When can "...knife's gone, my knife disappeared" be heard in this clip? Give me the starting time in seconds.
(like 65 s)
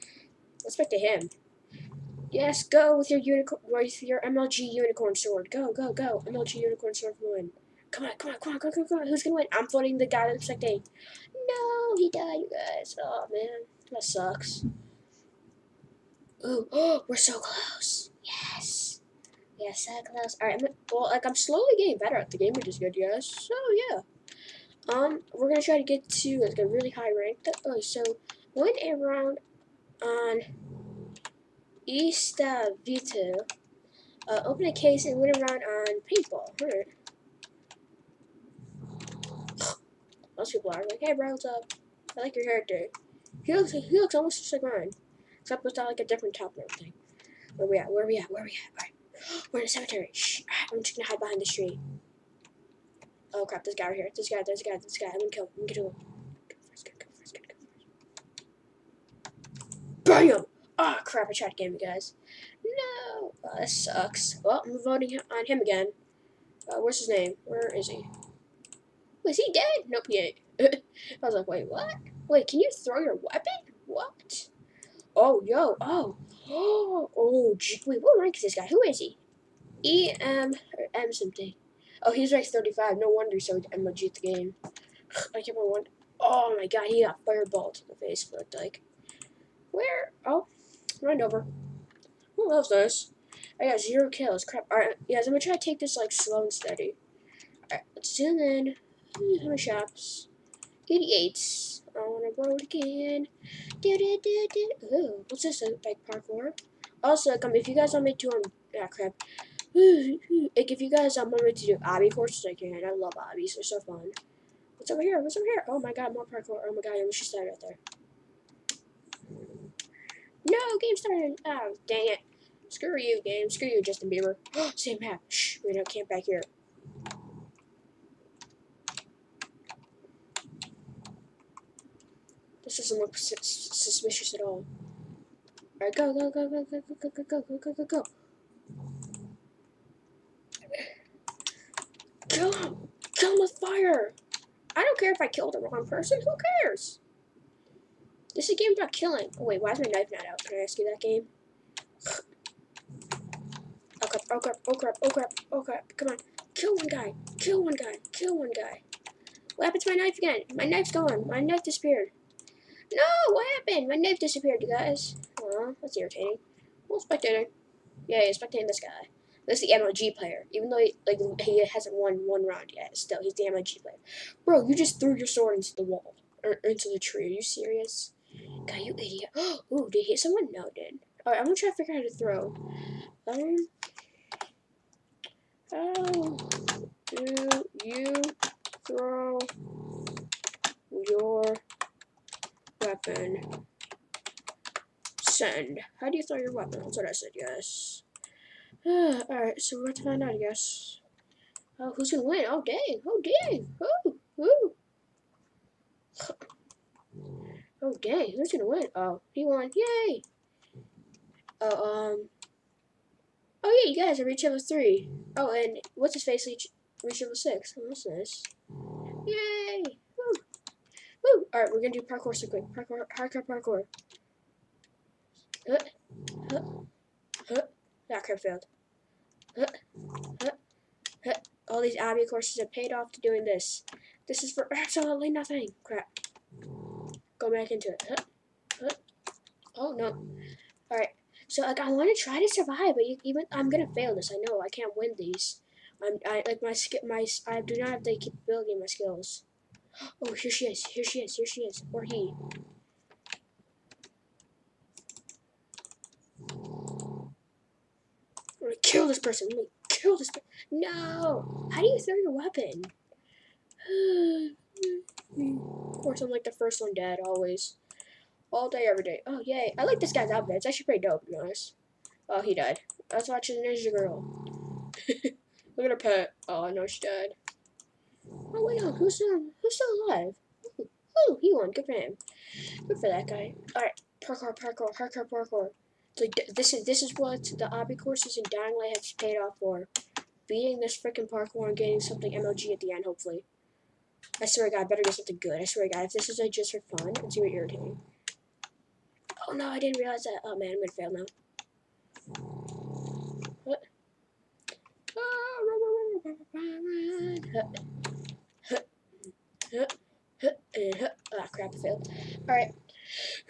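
160 s.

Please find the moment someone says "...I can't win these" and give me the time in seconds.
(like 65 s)
244 s.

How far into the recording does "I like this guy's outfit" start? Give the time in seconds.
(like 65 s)
269 s.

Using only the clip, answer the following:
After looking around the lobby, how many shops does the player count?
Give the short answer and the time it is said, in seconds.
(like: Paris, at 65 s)
88, at 100 s.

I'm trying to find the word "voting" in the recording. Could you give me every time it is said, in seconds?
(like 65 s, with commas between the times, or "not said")
9 s, 64 s.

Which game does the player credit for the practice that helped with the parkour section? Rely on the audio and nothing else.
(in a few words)
Dying Light.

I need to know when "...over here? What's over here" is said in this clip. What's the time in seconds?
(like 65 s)
114 s.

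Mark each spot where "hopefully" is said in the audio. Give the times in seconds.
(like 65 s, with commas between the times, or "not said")
293 s.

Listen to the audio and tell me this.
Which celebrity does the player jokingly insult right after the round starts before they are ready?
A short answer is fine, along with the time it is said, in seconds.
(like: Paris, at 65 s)
Justin Bieber, at 123 s.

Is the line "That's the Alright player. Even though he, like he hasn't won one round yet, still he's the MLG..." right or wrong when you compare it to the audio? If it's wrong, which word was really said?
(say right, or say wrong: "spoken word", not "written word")
wrong: "MLG", not "Alright".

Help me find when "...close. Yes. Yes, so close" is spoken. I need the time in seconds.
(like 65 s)
17 s.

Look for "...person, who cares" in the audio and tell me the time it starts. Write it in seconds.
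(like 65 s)
145 s.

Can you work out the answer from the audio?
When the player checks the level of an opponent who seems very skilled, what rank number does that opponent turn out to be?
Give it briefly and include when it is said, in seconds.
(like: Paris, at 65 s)
35, at 82 s.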